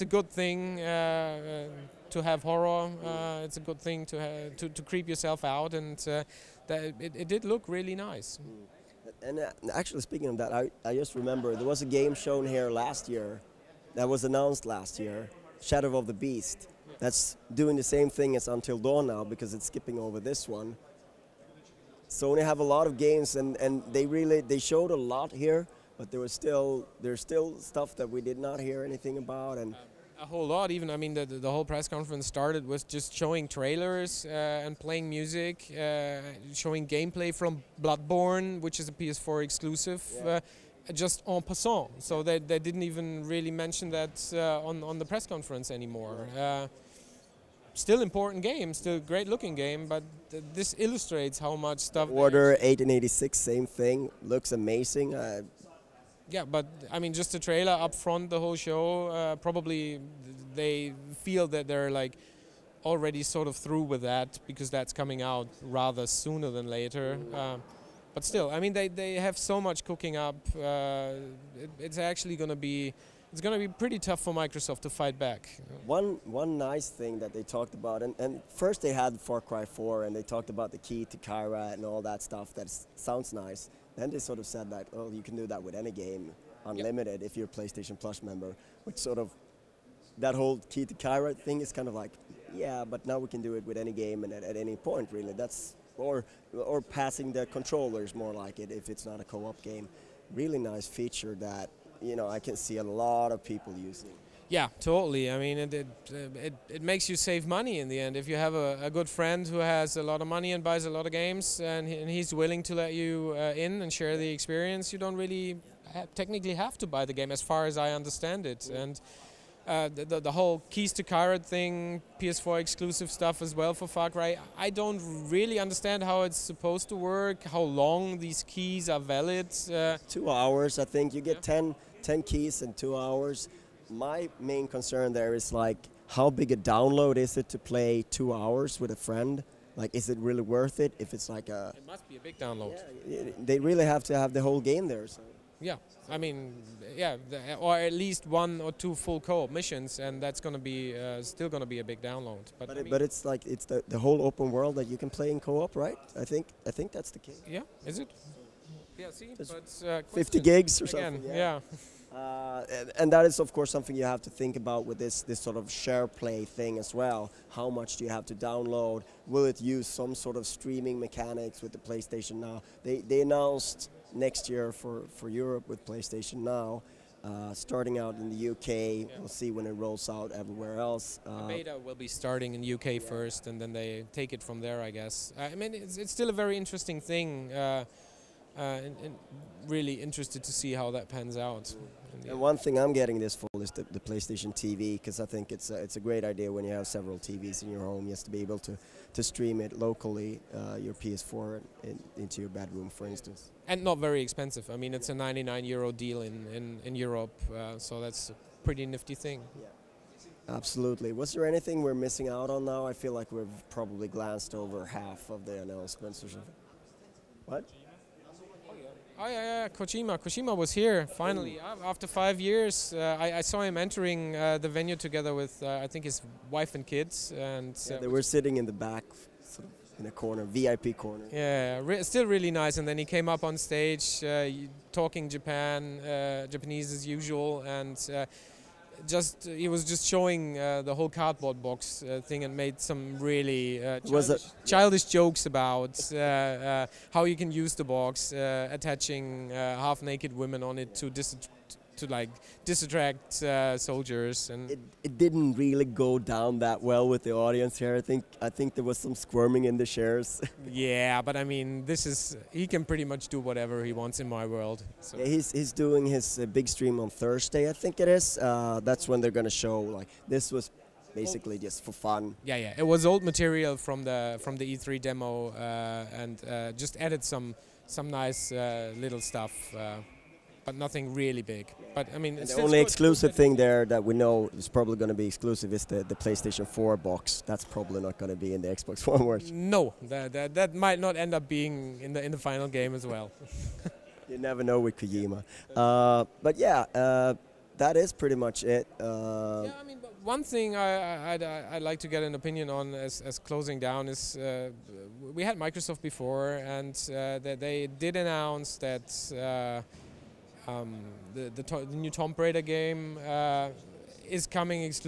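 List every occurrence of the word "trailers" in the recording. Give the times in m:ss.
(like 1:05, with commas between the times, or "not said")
0:33, 0:57.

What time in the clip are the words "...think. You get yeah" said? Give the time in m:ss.
2:10.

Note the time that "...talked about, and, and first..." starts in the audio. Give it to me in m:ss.
1:17.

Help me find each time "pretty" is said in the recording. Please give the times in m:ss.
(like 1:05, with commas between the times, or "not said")
1:13, 3:28, 4:22, 4:58.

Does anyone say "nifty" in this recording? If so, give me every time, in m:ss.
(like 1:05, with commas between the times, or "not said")
3:28.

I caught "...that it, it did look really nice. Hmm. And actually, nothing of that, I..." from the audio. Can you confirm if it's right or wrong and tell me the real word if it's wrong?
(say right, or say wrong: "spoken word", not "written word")
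wrong: "speaking", not "nothing".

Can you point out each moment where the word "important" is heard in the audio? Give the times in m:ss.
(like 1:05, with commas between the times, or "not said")
0:48.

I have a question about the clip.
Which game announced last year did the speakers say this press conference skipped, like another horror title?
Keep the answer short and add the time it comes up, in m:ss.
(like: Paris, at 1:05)
Shadow of the Beast, at 0:15.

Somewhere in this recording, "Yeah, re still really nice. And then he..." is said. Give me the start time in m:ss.
3:51.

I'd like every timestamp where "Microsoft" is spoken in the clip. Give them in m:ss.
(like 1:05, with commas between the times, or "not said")
1:14, 5:05.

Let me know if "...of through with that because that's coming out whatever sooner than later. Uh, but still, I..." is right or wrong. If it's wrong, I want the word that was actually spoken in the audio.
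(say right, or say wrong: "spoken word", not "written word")
wrong: "rather", not "whatever".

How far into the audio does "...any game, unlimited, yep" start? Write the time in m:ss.
1:25.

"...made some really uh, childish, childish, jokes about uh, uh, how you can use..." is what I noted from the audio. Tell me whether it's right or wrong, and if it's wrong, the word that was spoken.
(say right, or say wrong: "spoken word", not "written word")
right.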